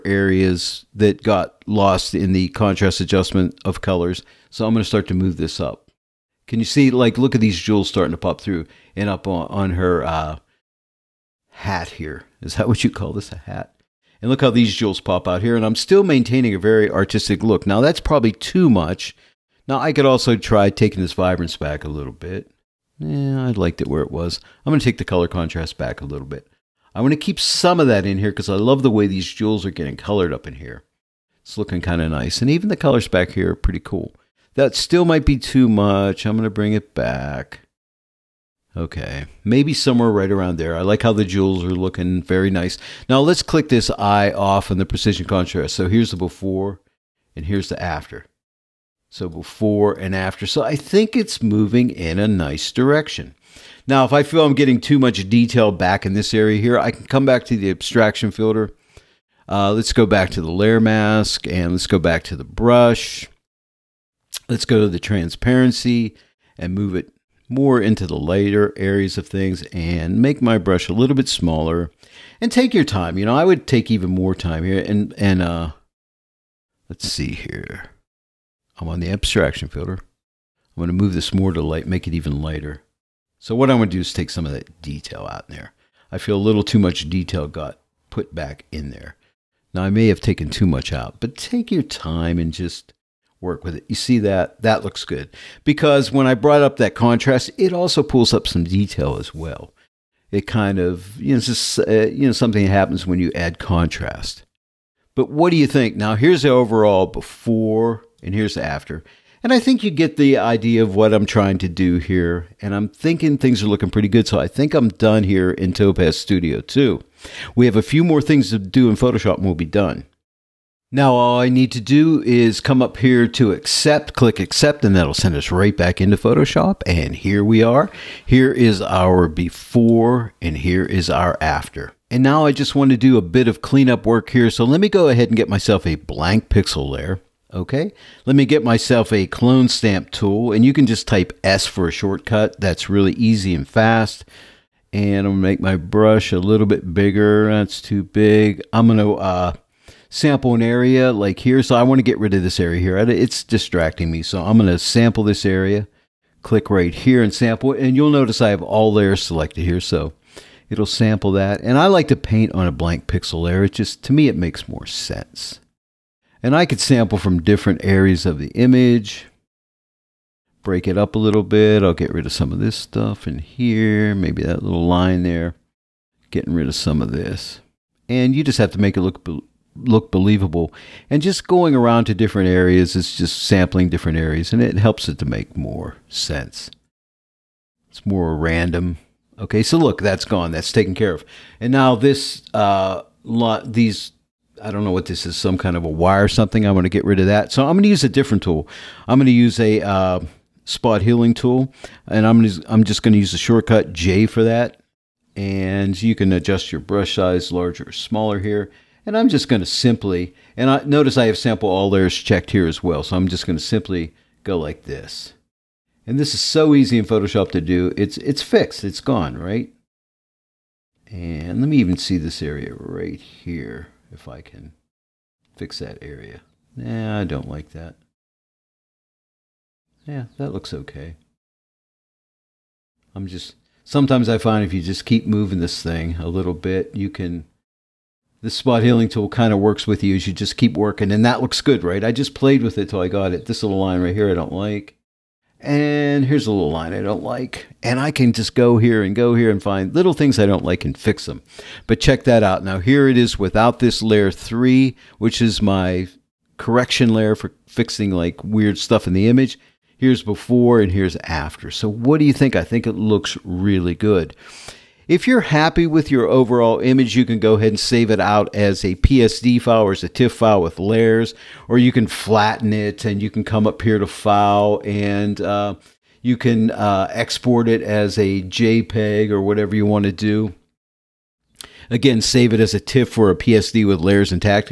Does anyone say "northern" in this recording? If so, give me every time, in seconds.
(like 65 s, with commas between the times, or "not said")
not said.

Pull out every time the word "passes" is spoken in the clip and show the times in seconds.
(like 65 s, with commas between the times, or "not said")
not said.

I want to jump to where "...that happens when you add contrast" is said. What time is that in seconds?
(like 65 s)
102 s.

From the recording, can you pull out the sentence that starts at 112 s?
And I'm thinking things are looking pretty good.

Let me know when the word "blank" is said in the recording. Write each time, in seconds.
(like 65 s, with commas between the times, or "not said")
135 s, 162 s.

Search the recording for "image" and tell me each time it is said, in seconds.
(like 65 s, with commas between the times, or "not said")
168 s, 259 s, 266 s.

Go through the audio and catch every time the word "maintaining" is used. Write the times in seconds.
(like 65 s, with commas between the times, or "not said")
16 s.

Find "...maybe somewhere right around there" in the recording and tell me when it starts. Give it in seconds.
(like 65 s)
39 s.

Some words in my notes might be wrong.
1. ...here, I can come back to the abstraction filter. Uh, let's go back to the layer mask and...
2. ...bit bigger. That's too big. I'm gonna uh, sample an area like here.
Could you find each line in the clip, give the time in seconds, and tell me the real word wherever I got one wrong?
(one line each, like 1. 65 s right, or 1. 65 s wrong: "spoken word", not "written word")
1. 56 s right
2. 146 s right.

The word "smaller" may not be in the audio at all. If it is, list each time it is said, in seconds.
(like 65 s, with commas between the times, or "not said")
71 s, 207 s.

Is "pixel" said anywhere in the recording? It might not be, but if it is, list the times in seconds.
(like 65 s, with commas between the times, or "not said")
136 s, 163 s.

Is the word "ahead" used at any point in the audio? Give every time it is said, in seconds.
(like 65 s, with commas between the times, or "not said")
135 s, 267 s.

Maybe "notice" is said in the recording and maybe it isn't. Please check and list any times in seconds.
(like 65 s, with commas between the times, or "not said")
158 s, 210 s.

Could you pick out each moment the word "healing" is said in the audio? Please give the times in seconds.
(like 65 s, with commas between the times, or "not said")
201 s, 238 s.